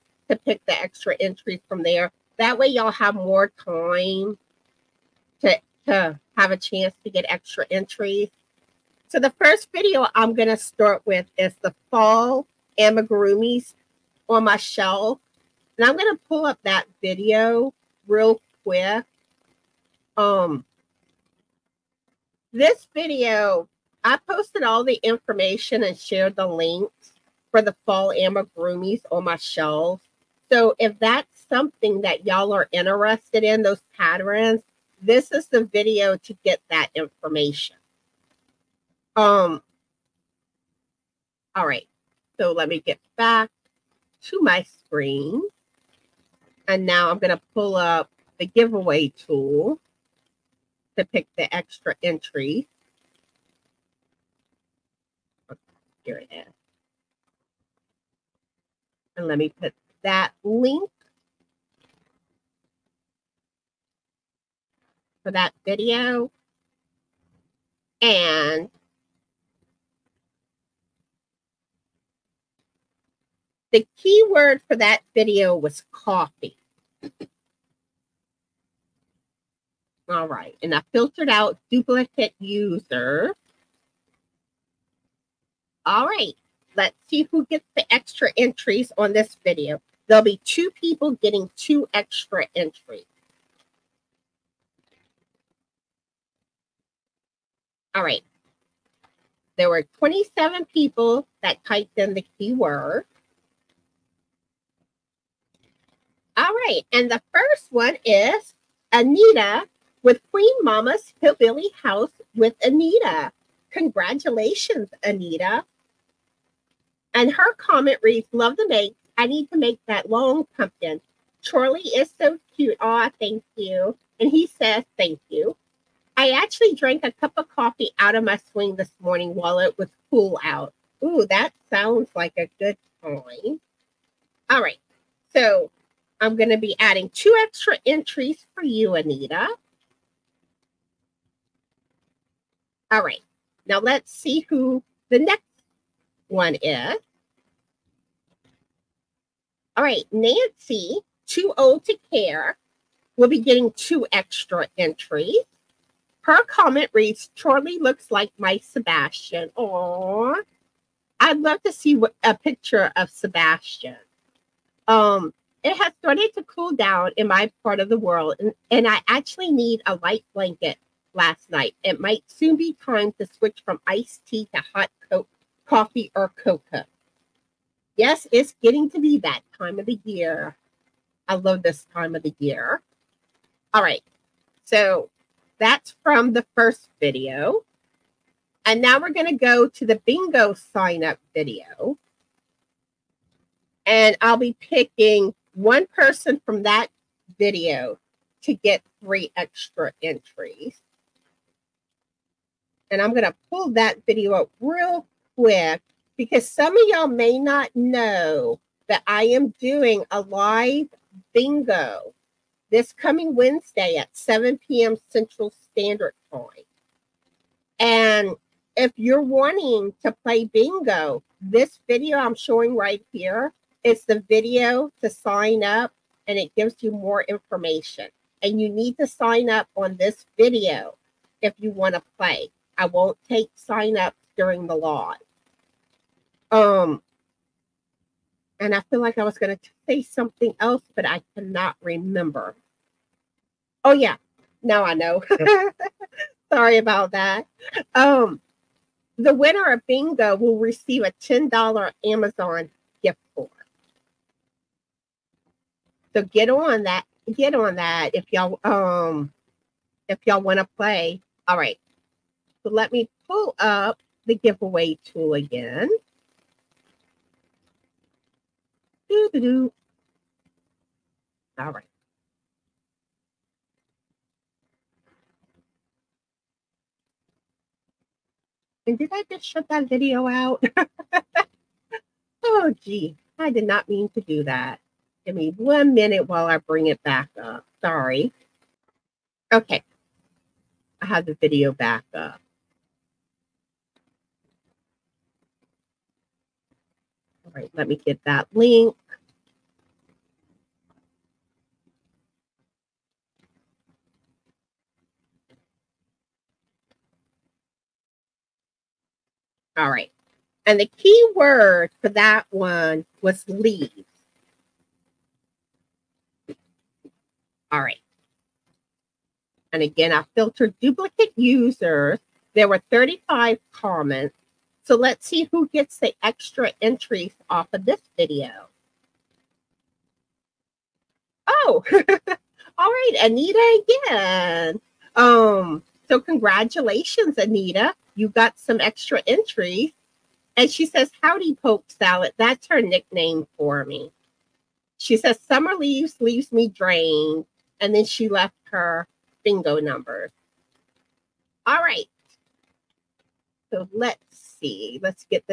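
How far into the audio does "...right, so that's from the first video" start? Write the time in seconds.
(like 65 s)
183 s.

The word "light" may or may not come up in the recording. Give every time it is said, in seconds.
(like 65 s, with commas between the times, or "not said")
169 s.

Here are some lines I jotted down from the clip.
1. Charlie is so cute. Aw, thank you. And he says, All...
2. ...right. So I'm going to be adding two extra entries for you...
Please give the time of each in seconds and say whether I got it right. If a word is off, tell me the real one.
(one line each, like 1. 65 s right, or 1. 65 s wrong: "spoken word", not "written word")
1. 121 s wrong: "Thank", not "All"
2. 134 s right.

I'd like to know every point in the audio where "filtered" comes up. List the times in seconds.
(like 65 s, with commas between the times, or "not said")
80 s, 320 s.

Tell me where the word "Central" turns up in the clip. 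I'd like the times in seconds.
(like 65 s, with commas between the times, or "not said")
215 s.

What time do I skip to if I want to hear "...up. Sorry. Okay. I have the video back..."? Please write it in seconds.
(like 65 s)
287 s.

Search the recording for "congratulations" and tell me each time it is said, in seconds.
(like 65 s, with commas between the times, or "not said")
113 s, 336 s.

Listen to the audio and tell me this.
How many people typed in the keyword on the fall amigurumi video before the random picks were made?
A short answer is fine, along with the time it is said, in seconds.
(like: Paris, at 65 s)
27, at 99 s.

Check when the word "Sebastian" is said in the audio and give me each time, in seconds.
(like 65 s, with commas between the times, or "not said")
158 s, 163 s.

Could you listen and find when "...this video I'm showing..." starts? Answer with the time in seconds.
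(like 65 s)
221 s.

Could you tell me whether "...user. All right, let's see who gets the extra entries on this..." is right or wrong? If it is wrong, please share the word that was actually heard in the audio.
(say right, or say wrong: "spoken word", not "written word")
right.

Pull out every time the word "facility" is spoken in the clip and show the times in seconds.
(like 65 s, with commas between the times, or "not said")
not said.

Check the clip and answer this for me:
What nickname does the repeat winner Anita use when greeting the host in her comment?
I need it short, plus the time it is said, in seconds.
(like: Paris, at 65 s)
Pope Salad, at 341 s.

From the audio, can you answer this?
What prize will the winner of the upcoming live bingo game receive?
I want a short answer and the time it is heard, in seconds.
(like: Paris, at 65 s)
$10 Amazon gift card, at 251 s.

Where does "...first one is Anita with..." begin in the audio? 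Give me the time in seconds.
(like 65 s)
107 s.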